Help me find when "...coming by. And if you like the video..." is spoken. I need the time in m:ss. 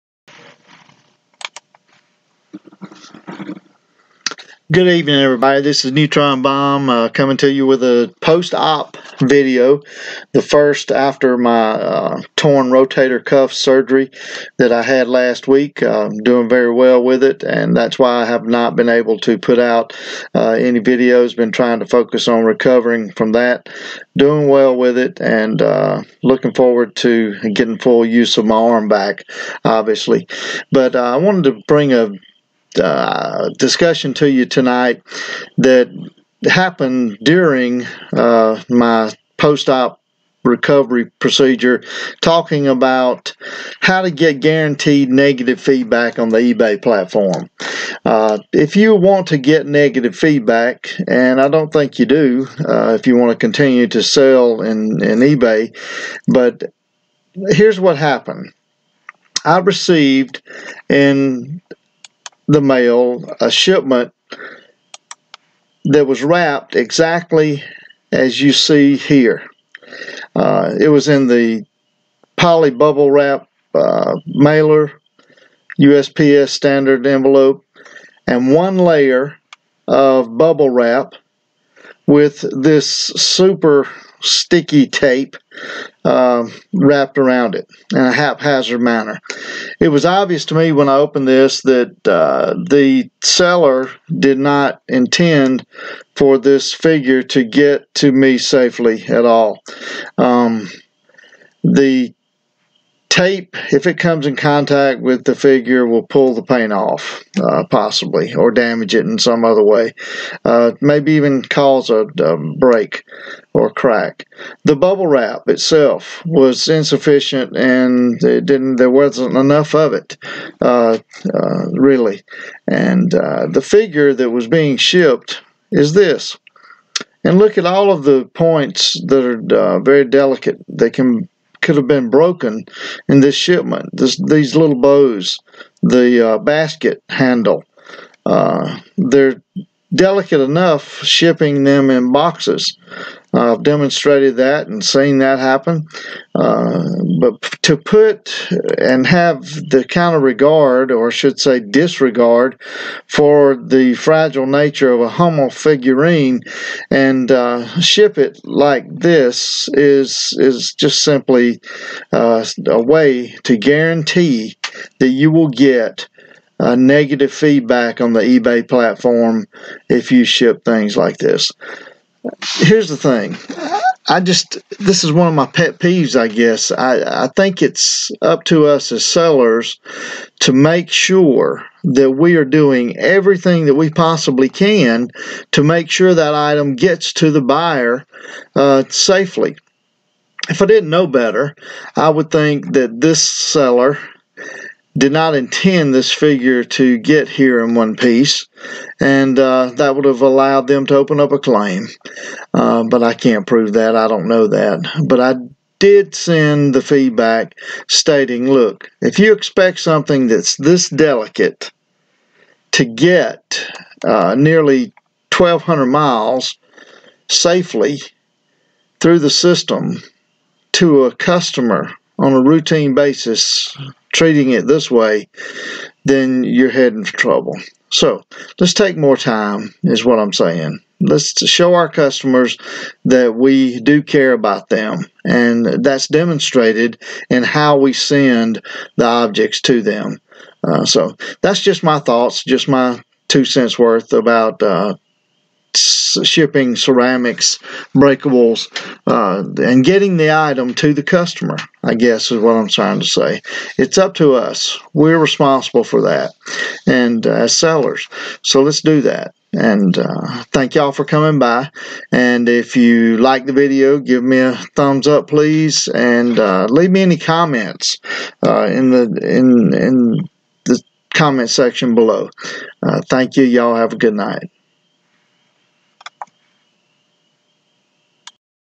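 4:21.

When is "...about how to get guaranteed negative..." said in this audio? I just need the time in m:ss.
0:42.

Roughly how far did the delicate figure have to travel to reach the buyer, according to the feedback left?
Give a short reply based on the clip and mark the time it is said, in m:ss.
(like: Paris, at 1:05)
1,200 miles, at 3:35.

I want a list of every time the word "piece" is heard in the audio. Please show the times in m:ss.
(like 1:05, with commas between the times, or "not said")
3:17.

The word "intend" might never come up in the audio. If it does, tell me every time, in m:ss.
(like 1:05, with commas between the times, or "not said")
1:34, 3:15.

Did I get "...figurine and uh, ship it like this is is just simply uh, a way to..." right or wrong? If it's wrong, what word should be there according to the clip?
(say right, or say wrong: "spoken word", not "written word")
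right.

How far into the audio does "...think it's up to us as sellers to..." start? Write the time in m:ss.
2:57.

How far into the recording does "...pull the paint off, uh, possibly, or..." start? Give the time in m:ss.
1:46.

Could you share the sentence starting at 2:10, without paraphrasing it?
They can could have been broken in this shipment.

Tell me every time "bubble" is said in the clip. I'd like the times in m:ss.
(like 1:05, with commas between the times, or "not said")
1:12, 1:20, 1:54.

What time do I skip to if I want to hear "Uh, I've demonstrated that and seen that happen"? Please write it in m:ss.
2:23.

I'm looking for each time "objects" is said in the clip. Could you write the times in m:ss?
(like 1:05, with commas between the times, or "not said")
3:59.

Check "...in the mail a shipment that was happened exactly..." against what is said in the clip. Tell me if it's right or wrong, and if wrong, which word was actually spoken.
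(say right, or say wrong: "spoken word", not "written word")
wrong: "wrapped", not "happened".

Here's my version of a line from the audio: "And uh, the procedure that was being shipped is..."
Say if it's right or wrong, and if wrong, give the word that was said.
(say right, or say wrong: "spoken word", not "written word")
wrong: "figure", not "procedure".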